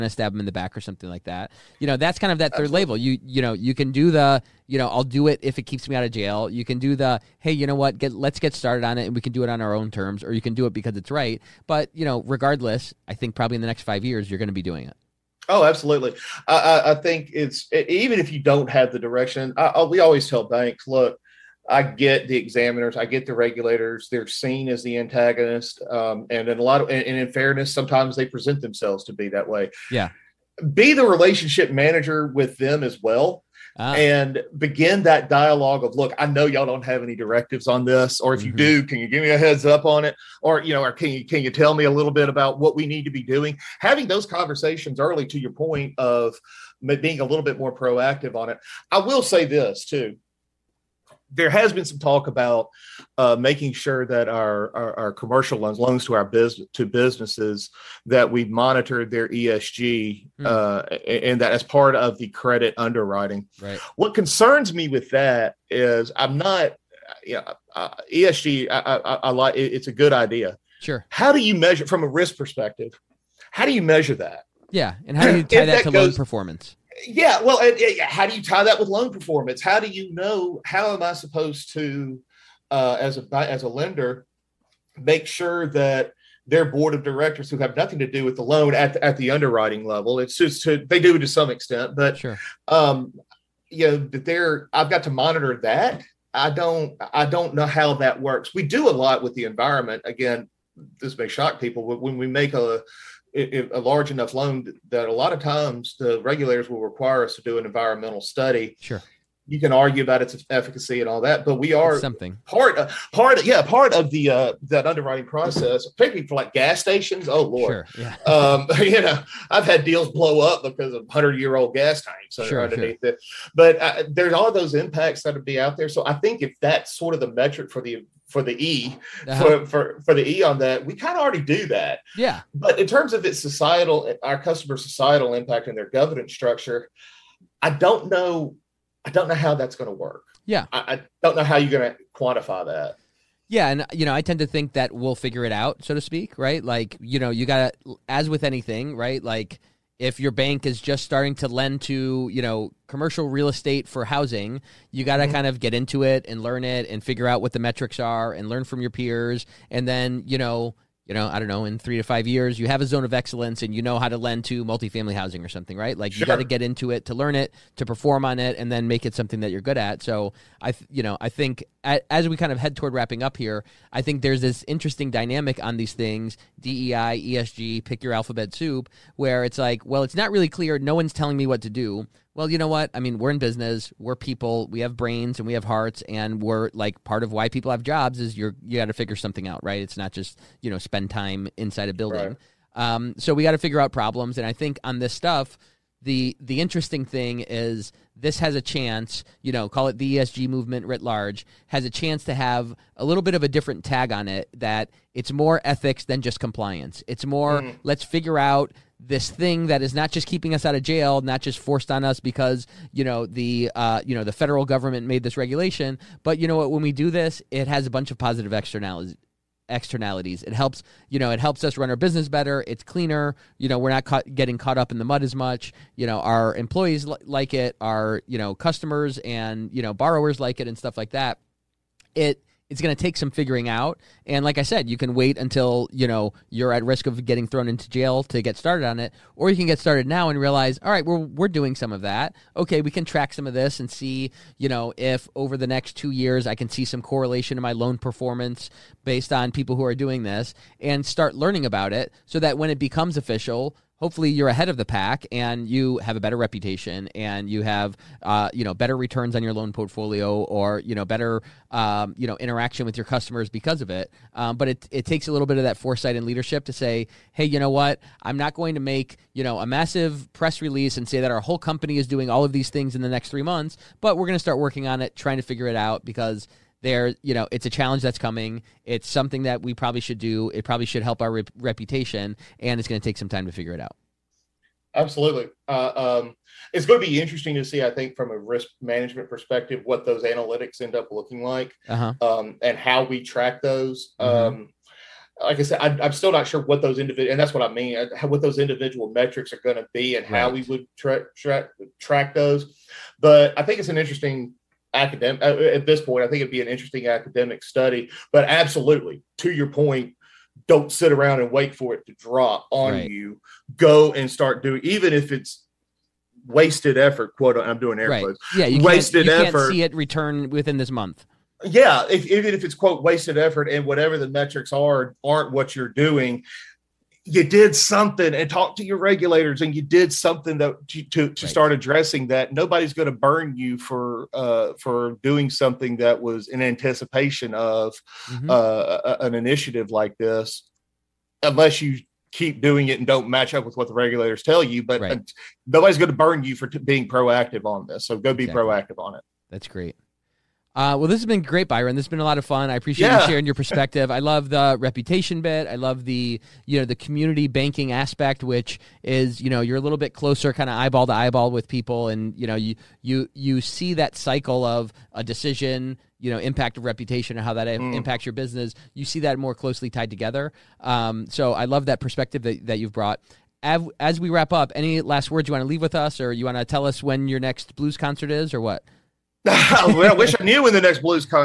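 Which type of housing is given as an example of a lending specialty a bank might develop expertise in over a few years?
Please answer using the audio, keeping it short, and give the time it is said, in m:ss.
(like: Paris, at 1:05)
multifamily housing, at 2:44.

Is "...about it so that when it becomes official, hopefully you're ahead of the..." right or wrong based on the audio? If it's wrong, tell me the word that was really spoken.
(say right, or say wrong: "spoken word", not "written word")
right.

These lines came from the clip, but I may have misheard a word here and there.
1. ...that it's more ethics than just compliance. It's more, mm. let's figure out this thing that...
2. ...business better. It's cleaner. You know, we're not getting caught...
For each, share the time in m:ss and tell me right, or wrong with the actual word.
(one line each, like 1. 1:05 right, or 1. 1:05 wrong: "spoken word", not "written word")
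1. 3:24 right
2. 3:41 right.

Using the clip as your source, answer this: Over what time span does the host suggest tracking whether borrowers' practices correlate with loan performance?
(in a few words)
2 years.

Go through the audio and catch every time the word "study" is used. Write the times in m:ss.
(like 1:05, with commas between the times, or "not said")
1:48, 5:07.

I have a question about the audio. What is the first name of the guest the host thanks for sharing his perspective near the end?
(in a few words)
Byron.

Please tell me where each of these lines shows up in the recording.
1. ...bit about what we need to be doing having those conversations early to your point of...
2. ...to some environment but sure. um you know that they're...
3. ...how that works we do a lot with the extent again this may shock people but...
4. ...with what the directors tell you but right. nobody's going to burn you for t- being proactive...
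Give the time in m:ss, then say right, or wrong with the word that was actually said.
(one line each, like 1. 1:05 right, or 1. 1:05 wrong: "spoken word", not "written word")
1. 0:42 right
2. 1:31 wrong: "extent", not "environment"
3. 1:37 wrong: "environment", not "extent"
4. 5:43 wrong: "regulators", not "directors".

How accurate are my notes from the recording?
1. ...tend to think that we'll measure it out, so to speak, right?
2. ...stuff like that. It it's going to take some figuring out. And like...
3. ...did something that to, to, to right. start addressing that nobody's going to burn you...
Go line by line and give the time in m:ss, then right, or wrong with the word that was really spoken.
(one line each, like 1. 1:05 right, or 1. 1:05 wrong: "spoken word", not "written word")
1. 2:24 wrong: "figure", not "measure"
2. 3:50 right
3. 5:29 right.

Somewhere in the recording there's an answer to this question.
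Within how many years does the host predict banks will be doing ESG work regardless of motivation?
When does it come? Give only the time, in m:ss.
0:13.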